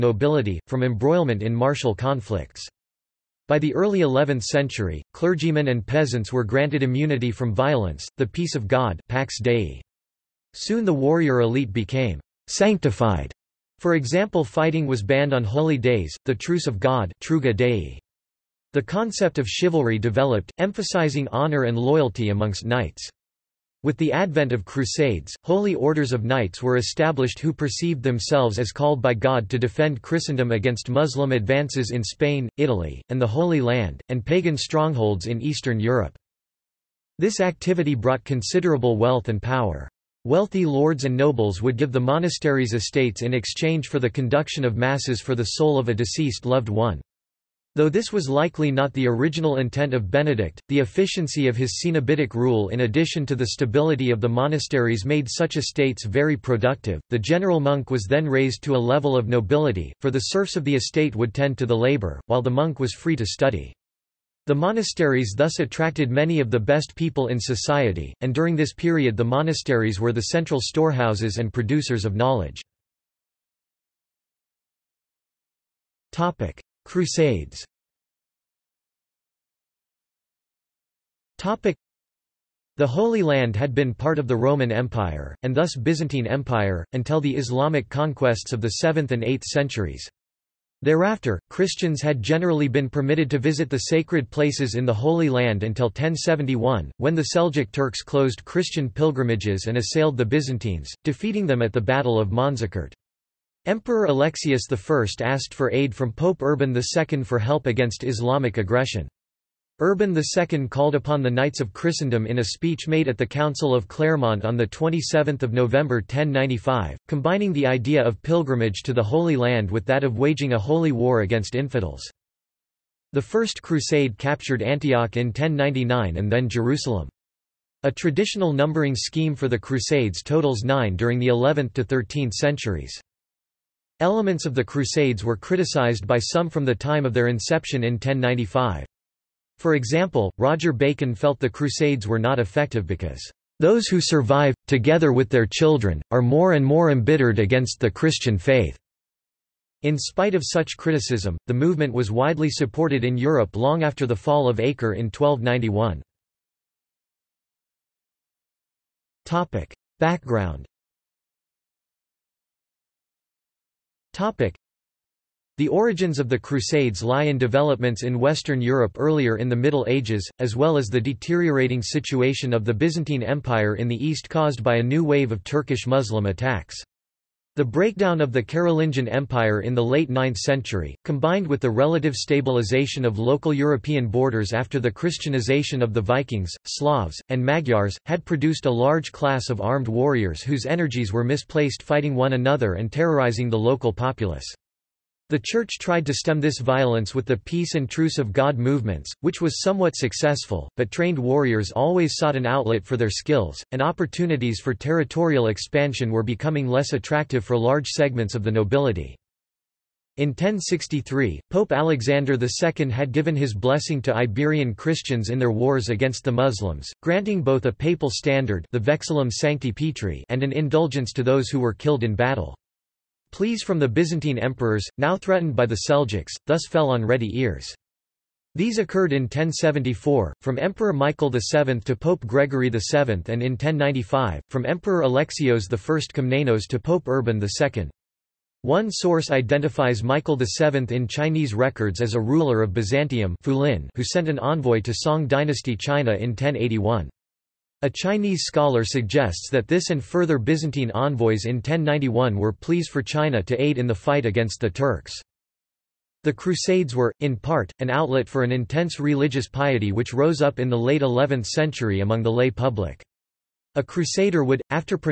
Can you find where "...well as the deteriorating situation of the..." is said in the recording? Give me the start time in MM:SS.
02:50.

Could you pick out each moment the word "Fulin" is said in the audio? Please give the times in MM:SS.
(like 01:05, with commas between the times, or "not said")
04:03.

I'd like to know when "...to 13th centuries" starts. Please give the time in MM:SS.
02:11.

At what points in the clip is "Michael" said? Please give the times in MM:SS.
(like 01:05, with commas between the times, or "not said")
03:50, 04:00.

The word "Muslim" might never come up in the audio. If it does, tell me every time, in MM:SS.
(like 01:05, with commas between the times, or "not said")
00:30, 02:55, 03:36.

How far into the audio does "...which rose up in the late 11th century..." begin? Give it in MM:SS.
04:19.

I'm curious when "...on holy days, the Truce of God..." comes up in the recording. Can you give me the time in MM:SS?
00:15.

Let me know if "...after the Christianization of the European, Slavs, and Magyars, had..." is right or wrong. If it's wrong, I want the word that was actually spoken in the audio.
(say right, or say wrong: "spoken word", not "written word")
wrong: "Vikings", not "European".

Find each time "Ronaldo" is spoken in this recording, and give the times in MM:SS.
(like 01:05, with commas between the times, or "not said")
not said.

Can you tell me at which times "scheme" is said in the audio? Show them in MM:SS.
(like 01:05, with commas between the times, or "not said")
02:08.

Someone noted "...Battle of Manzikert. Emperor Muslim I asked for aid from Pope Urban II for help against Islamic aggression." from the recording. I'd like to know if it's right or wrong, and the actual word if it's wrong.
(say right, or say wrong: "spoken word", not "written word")
wrong: "Alexius", not "Muslim".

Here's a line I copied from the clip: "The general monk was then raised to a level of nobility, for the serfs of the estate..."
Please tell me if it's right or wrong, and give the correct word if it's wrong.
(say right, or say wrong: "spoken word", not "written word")
right.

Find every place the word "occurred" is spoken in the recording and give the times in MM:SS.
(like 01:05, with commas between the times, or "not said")
03:48.